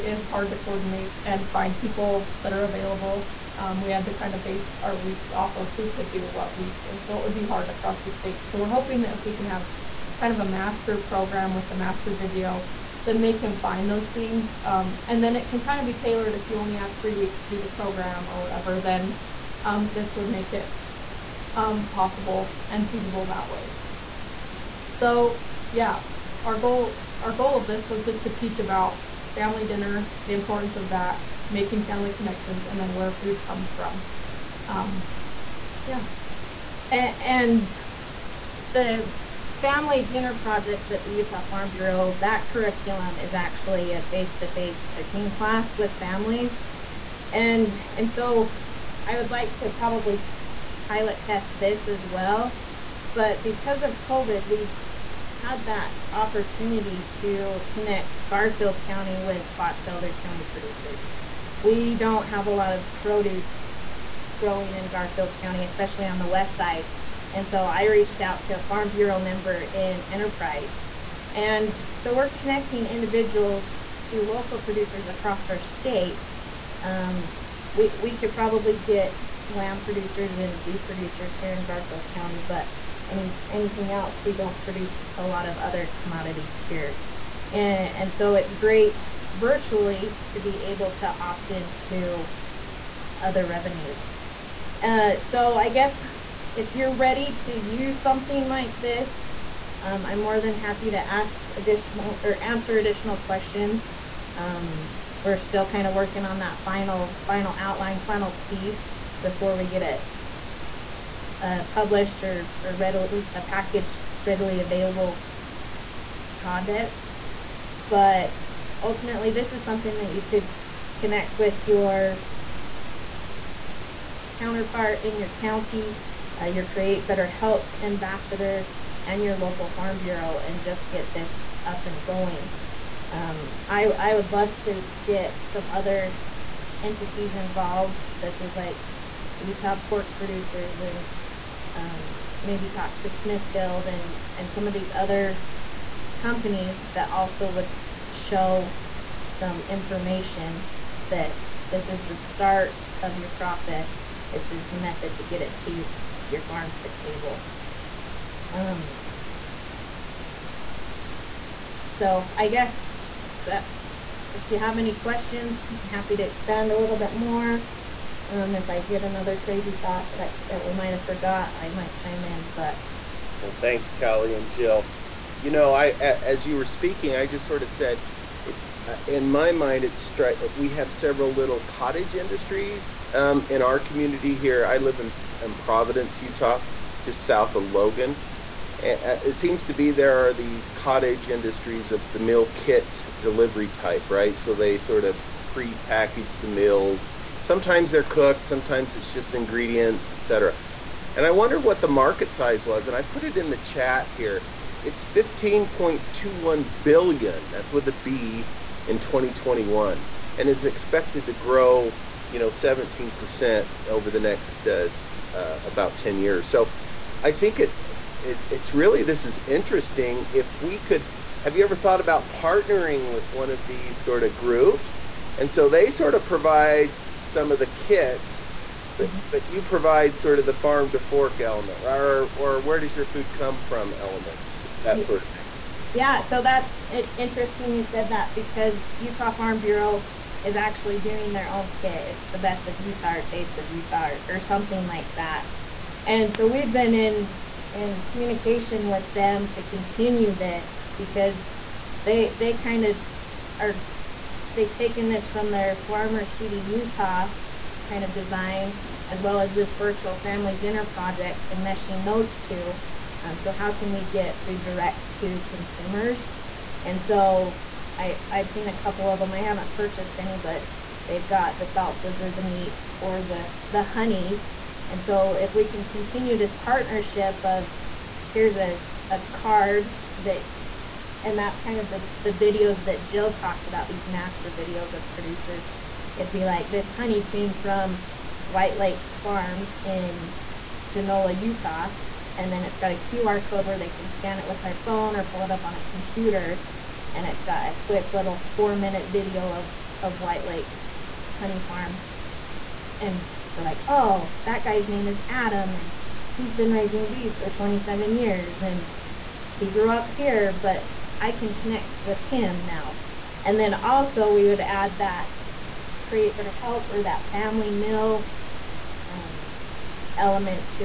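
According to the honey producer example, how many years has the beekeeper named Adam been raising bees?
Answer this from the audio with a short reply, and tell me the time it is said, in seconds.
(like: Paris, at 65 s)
27, at 307 s.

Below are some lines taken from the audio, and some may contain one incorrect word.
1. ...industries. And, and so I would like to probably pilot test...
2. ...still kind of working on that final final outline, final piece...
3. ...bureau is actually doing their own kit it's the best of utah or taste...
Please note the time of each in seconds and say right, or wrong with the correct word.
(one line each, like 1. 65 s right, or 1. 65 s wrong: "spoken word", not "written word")
1. 45 s wrong: "families", not "industries"
2. 105 s right
3. 239 s right.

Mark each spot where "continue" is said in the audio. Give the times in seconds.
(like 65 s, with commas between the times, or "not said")
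249 s, 275 s.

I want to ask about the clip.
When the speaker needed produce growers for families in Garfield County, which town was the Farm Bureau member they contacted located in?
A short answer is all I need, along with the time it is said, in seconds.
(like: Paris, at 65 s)
Enterprise, at 70 s.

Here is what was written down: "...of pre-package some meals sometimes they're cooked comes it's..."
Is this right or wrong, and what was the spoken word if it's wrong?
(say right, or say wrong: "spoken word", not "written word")
wrong: "sometimes", not "comes".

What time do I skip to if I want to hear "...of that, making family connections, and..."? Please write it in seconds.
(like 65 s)
30 s.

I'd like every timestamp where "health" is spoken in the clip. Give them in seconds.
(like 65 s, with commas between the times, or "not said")
127 s, 316 s.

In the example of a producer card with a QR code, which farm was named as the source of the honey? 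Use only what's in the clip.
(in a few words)
White Lakes Farms.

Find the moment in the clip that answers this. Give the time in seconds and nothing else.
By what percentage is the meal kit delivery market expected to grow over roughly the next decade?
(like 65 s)
212 s.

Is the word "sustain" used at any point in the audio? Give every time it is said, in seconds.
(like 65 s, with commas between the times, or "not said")
not said.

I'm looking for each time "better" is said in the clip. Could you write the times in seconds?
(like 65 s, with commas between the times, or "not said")
127 s, 316 s.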